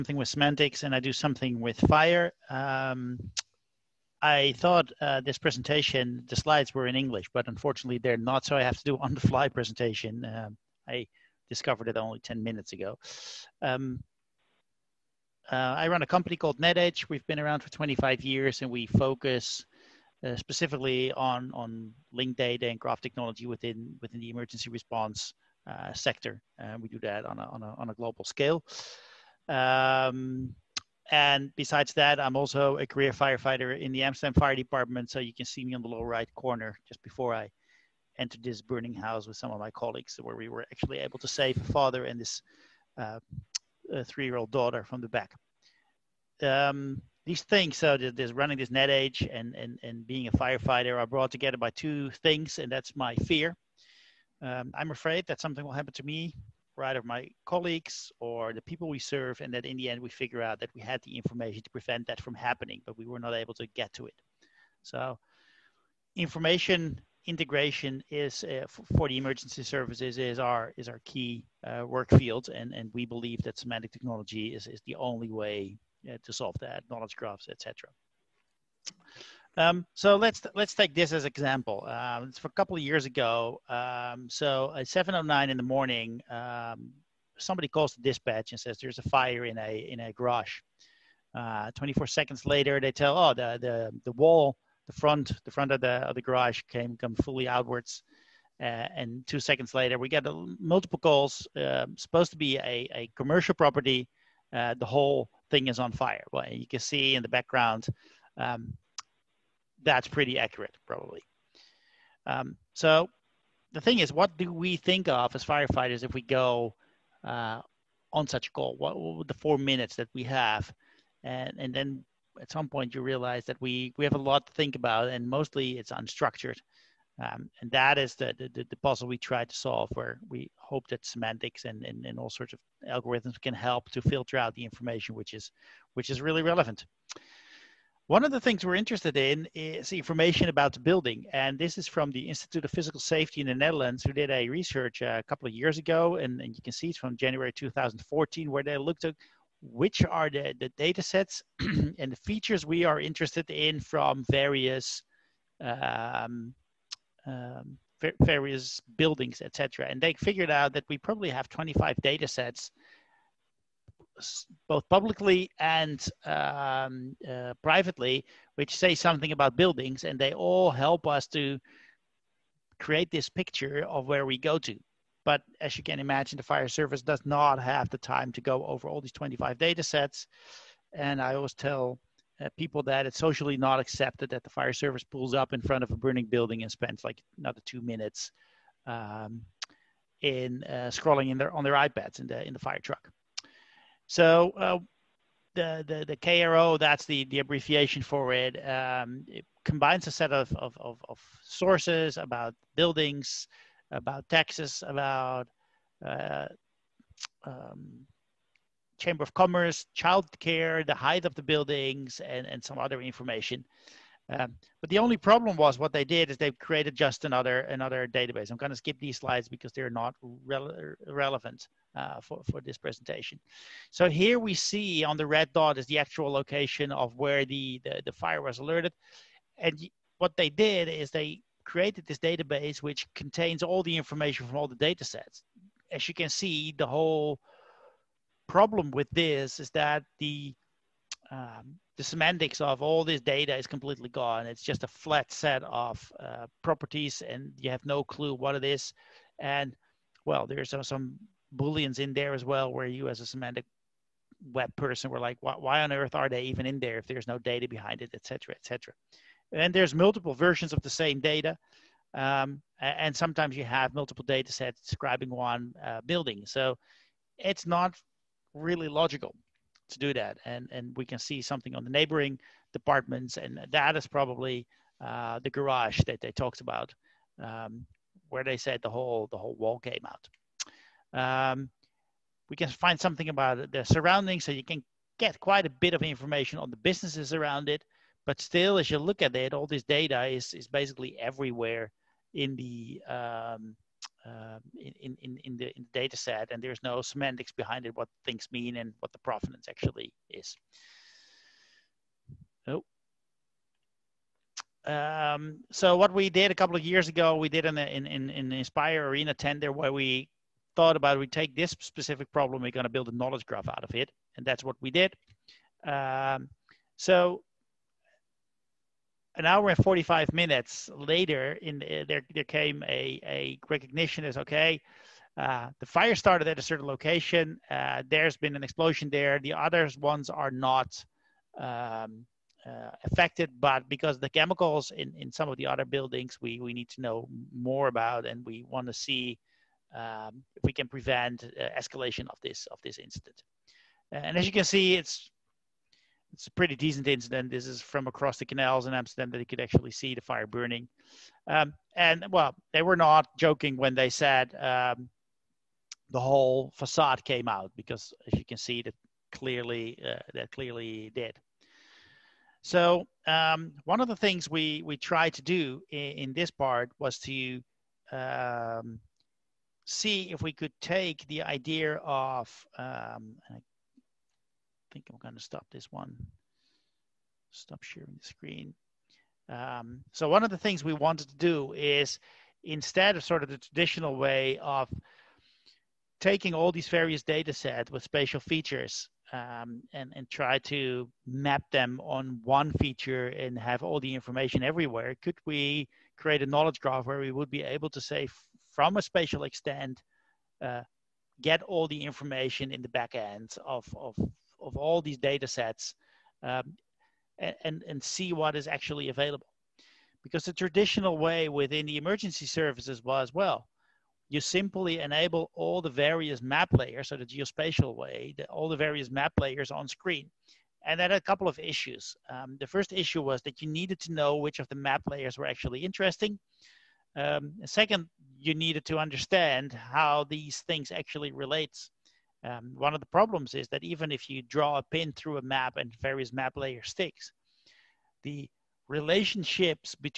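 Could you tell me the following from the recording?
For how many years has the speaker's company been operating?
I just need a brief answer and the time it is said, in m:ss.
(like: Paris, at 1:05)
25 years, at 0:17.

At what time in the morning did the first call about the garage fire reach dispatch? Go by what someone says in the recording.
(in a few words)
7:09.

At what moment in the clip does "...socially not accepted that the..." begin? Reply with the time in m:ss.
3:03.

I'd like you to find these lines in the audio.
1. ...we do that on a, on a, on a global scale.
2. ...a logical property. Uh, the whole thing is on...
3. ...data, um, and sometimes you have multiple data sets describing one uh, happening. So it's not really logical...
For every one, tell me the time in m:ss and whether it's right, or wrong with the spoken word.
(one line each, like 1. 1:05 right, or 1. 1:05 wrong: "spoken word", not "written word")
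1. 0:26 right
2. 1:42 wrong: "commercial", not "logical"
3. 4:21 wrong: "building", not "happening".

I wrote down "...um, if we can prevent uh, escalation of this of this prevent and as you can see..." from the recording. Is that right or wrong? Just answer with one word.
wrong.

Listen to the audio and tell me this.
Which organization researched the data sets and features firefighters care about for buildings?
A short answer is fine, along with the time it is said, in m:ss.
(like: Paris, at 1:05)
Institute of Physical Safety, at 2:22.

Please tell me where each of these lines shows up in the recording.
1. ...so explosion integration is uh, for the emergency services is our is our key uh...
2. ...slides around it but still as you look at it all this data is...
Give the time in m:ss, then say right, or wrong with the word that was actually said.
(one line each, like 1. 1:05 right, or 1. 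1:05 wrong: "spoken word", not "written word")
1. 1:04 wrong: "information", not "explosion"
2. 4:46 wrong: "businesses", not "slides".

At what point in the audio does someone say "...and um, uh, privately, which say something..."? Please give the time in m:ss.
2:45.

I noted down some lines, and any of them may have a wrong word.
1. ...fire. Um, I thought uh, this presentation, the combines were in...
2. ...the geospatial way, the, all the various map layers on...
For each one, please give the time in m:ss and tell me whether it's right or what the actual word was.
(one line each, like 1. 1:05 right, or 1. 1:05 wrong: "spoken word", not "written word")
1. 0:01 wrong: "slides", not "combines"
2. 6:57 right.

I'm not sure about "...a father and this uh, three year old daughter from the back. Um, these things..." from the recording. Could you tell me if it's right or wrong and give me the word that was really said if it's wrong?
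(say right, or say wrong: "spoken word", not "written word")
right.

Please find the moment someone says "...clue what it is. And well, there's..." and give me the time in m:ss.
4:08.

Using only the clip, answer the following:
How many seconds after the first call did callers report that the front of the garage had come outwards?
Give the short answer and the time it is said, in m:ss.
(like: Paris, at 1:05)
24, at 1:31.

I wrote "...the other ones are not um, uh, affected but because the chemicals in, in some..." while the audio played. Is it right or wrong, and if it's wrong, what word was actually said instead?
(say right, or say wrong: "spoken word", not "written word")
right.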